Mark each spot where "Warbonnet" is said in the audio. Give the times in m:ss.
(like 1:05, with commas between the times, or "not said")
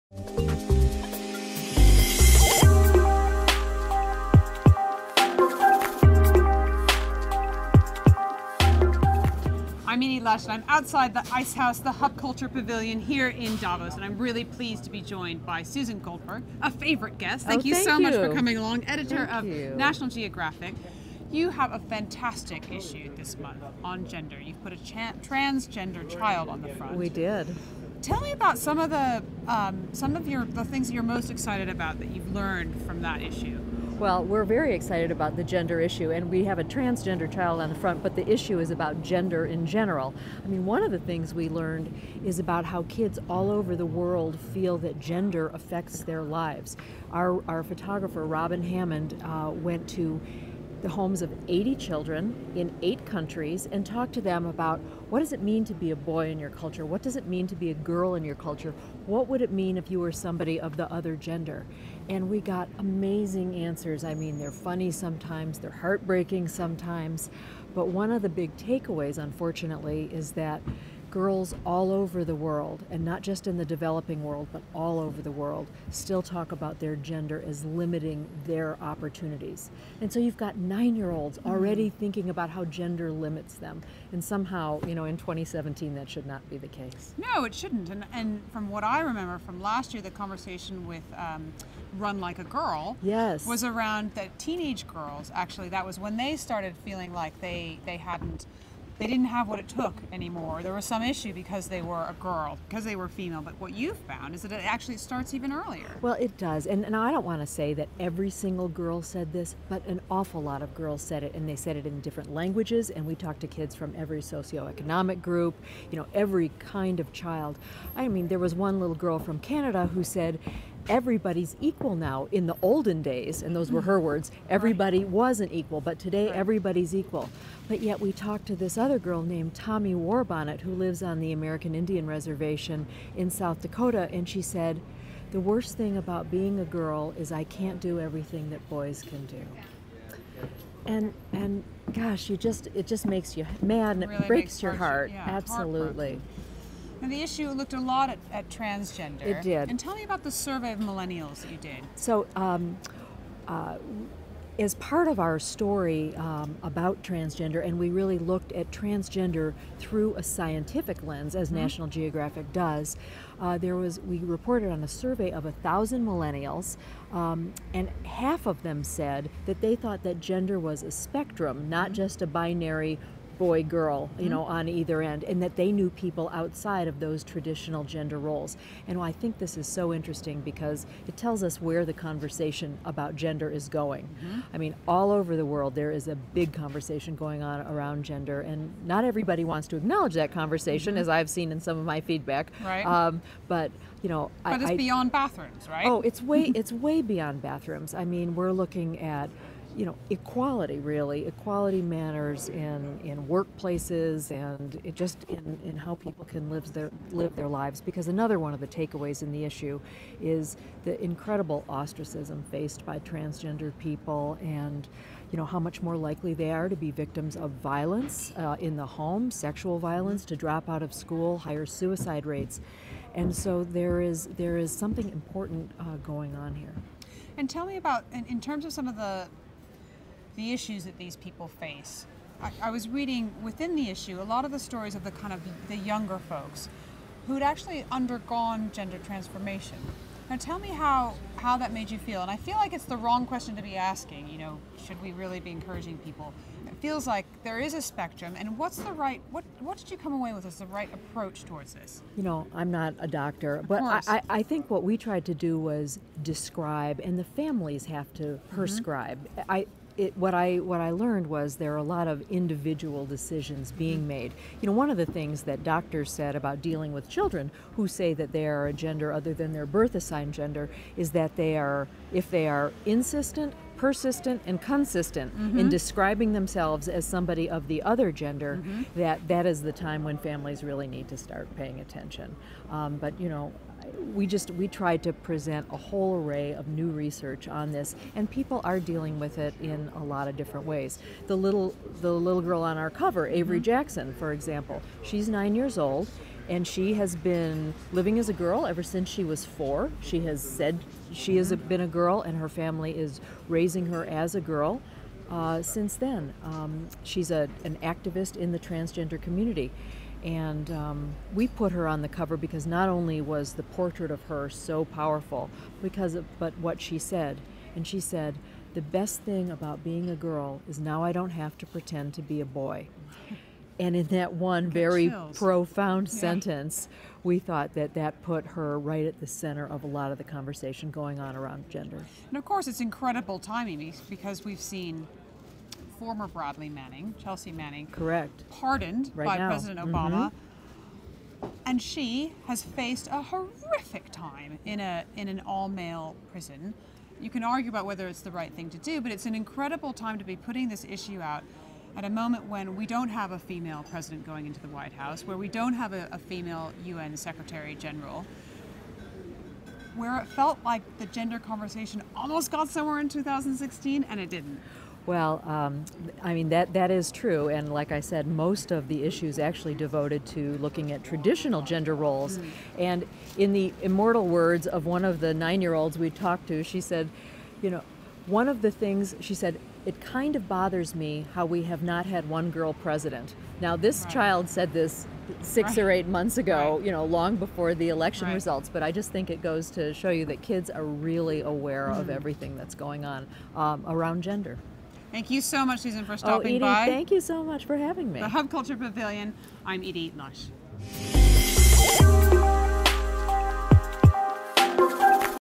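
2:09.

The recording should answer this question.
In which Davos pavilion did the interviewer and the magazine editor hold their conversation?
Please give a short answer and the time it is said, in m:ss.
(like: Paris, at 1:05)
Ice House, at 0:11.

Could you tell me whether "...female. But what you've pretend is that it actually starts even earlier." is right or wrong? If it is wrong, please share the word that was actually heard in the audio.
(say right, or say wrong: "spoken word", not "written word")
wrong: "found", not "pretend".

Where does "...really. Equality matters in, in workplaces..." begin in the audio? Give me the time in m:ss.
3:20.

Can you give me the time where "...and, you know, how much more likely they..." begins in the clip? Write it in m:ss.
3:34.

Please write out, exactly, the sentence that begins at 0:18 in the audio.
much for coming along, editor thank of you.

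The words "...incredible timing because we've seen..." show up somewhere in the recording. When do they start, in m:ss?
5:32.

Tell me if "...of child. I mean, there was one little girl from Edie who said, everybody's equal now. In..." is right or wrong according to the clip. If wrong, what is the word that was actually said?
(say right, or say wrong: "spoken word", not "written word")
wrong: "Canada", not "Edie".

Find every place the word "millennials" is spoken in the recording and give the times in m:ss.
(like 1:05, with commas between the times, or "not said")
2:30, 2:46.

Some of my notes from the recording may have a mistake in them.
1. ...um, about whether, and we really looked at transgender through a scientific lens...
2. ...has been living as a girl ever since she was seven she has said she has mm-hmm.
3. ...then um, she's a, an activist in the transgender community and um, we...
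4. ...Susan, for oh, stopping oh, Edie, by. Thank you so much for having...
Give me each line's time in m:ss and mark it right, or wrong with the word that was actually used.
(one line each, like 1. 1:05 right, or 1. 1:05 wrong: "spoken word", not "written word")
1. 2:36 wrong: "transgender", not "whether"
2. 4:56 wrong: "four", not "seven"
3. 5:05 right
4. 6:35 right.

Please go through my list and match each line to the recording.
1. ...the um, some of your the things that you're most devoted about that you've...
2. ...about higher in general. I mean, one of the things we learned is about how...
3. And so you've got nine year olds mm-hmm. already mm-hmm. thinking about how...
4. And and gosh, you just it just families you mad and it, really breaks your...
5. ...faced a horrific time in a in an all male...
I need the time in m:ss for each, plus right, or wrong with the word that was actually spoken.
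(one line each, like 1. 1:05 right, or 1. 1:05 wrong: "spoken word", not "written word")
1. 0:28 wrong: "excited", not "devoted"
2. 0:38 wrong: "gender", not "higher"
3. 1:19 right
4. 2:20 wrong: "makes", not "families"
5. 5:42 right.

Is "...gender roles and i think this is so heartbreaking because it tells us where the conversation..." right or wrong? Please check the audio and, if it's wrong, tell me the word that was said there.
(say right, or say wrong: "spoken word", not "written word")
wrong: "interesting", not "heartbreaking".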